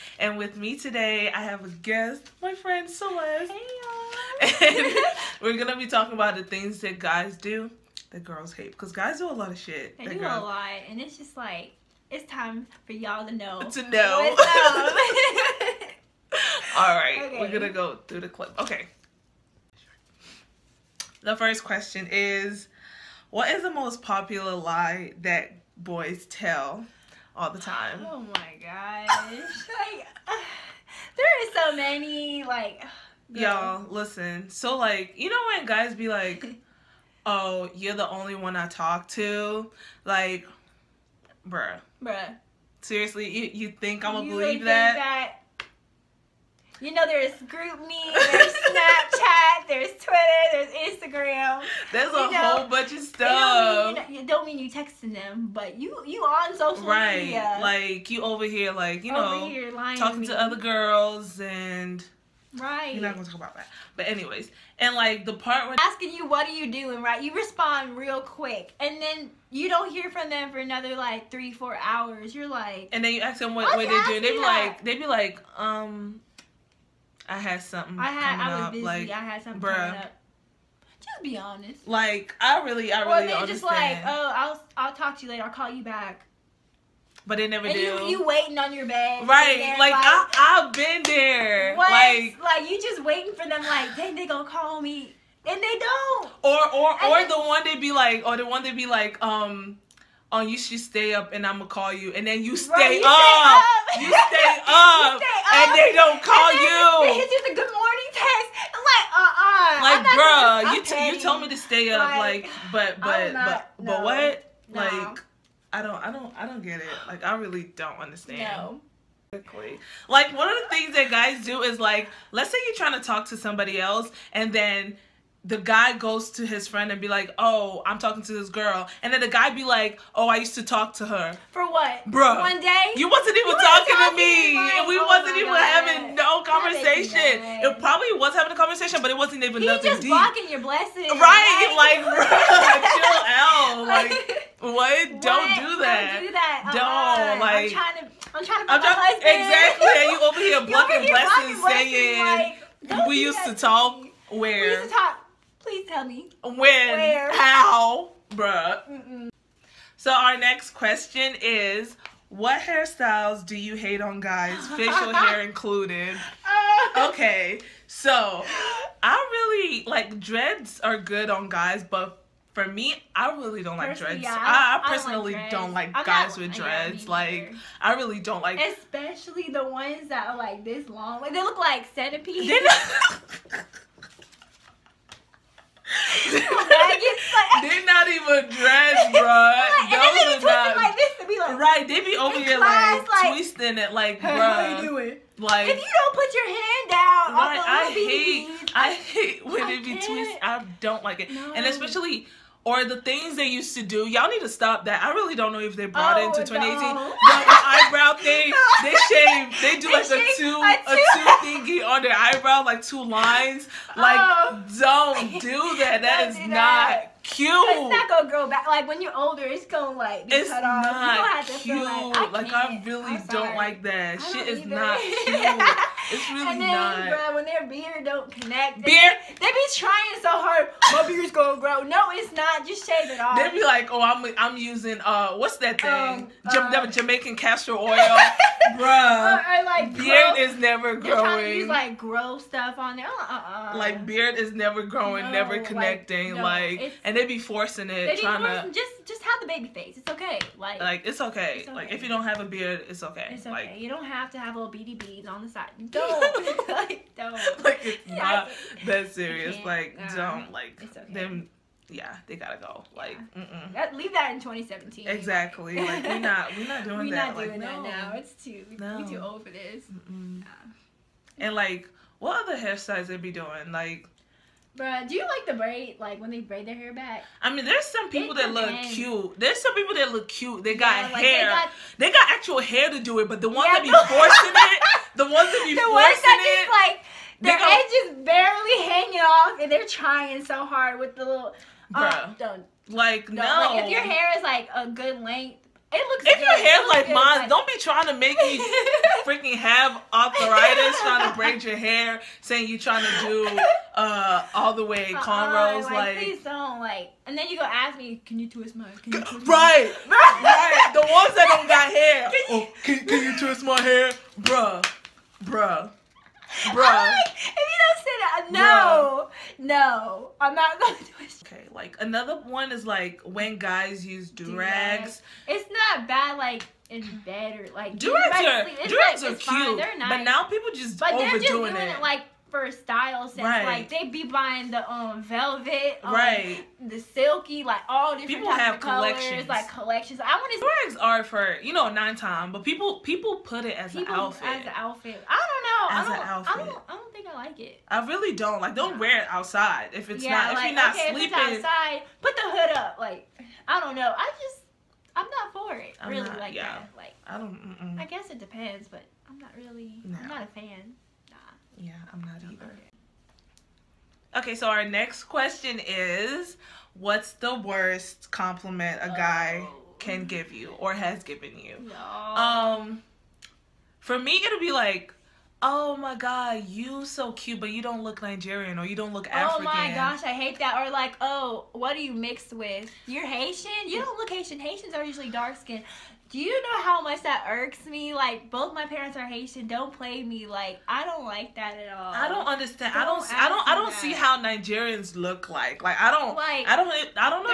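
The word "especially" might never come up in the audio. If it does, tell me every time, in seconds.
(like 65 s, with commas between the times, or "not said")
178 s, 201 s.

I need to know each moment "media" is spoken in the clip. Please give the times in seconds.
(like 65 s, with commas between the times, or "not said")
57 s.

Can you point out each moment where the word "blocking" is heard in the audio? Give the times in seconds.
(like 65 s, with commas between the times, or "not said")
140 s, 150 s.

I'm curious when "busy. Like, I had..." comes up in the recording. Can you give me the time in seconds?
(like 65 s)
78 s.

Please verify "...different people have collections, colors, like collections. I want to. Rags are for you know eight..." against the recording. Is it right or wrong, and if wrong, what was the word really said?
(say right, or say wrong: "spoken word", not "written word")
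wrong: "nine", not "eight".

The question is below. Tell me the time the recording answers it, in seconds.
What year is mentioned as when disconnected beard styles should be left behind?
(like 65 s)
264 s.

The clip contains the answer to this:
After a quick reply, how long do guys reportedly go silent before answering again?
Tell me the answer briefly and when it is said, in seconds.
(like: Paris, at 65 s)
3 to 4 hours, at 71 s.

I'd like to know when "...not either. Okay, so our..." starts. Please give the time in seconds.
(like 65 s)
362 s.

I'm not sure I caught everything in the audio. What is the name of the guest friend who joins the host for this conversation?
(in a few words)
Celeste.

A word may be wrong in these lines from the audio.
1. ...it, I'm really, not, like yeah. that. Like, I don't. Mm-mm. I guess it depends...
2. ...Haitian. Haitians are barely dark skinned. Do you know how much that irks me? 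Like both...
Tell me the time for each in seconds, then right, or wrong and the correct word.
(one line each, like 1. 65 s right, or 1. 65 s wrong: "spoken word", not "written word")
1. 355 s right
2. 384 s wrong: "usually", not "barely".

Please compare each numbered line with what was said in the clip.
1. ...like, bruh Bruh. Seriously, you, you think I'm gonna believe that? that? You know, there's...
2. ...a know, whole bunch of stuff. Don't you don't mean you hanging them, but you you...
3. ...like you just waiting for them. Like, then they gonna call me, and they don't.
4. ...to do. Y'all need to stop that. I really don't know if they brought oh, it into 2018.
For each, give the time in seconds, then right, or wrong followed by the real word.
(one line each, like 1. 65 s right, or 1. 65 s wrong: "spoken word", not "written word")
1. 40 s right
2. 52 s wrong: "texting", not "hanging"
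3. 92 s right
4. 203 s right.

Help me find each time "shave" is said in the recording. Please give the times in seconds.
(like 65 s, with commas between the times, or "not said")
209 s, 232 s.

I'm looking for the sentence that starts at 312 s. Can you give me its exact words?
oh, can, can you twist my hair, bruh?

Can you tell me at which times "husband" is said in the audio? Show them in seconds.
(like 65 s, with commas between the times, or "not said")
148 s.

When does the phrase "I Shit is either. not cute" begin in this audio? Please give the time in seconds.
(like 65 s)
224 s.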